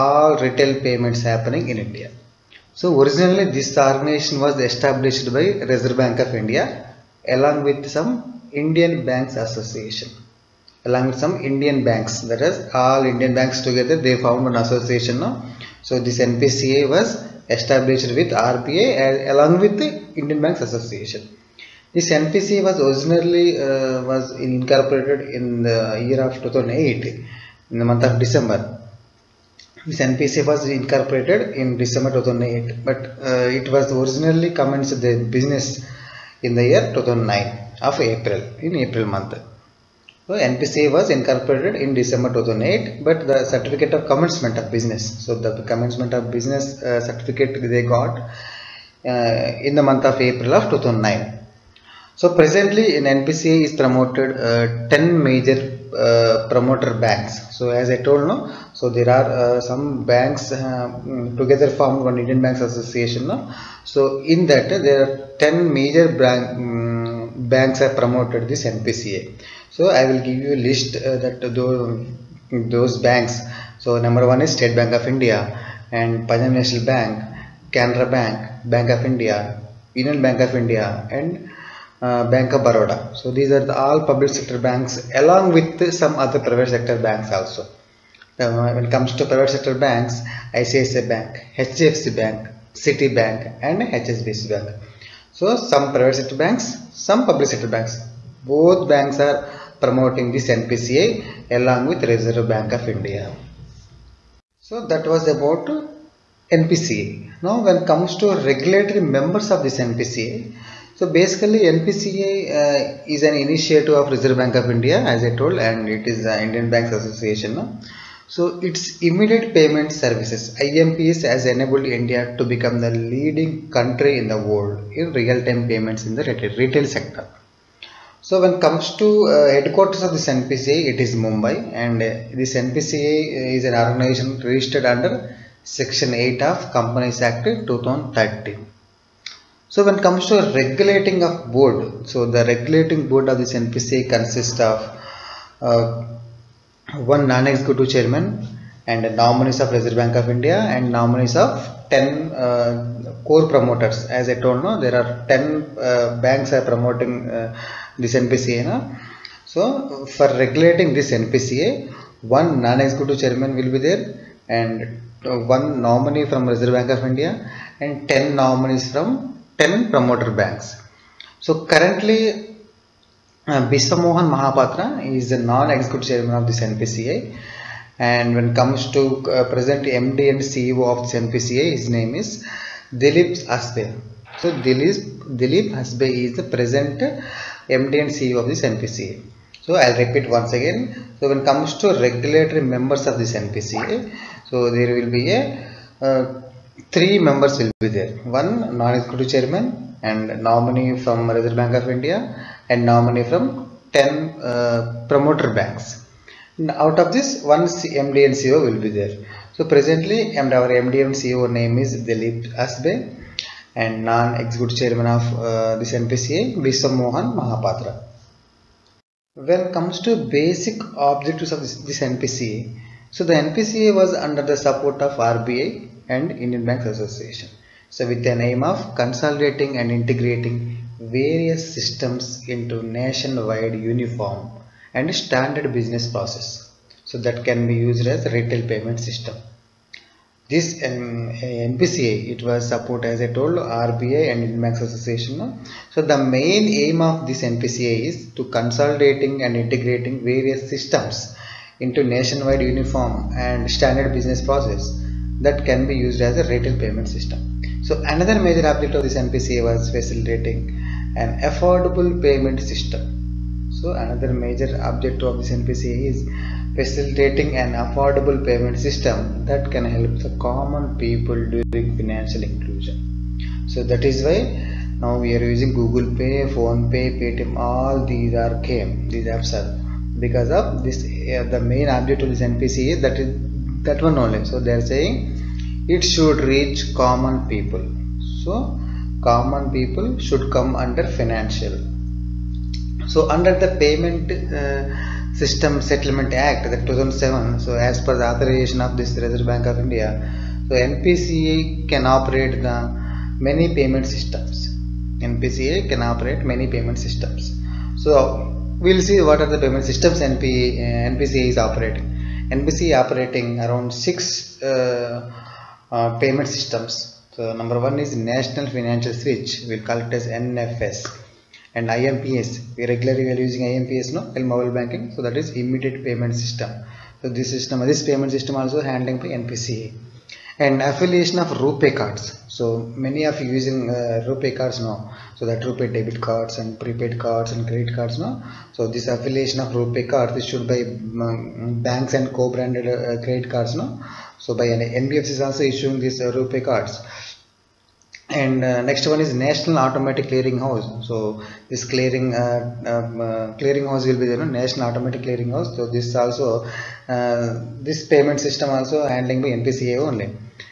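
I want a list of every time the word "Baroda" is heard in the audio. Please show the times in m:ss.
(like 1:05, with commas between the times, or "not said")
1:22.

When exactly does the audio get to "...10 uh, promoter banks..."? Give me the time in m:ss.
3:23.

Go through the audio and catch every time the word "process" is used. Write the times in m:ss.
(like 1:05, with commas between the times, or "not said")
3:56, 4:14.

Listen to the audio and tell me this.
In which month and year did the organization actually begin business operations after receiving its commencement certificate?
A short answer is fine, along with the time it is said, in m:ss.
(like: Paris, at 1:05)
April 2009, at 0:36.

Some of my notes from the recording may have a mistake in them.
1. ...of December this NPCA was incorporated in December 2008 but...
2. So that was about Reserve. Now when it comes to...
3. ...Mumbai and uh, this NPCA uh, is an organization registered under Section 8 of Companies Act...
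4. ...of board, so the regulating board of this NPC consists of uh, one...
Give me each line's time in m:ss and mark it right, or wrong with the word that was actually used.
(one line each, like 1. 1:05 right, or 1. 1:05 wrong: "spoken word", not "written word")
1. 0:28 right
2. 1:44 wrong: "NPCA", not "Reserve"
3. 2:11 right
4. 2:21 right.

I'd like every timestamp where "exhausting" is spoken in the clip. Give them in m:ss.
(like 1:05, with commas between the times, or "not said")
not said.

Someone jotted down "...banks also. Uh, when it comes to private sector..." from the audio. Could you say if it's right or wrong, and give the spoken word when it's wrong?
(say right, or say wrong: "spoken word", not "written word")
right.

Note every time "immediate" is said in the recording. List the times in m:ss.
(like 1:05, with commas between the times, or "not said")
1:59, 5:25.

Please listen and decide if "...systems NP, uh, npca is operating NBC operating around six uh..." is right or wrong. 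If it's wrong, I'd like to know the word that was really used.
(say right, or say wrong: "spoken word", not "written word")
right.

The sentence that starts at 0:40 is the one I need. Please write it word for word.
So NPC was incorporated in December 2008 but the certificate of commencement of business.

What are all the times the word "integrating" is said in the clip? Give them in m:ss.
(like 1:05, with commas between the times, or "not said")
3:49, 4:09.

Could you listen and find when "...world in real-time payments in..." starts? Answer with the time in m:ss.
2:04.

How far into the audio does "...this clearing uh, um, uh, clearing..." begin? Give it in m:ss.
5:51.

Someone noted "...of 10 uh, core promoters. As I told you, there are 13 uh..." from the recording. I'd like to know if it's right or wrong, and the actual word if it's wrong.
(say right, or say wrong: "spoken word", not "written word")
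wrong: "10", not "13".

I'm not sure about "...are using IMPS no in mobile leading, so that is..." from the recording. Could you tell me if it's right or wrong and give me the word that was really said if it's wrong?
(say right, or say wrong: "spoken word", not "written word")
wrong: "banking", not "leading".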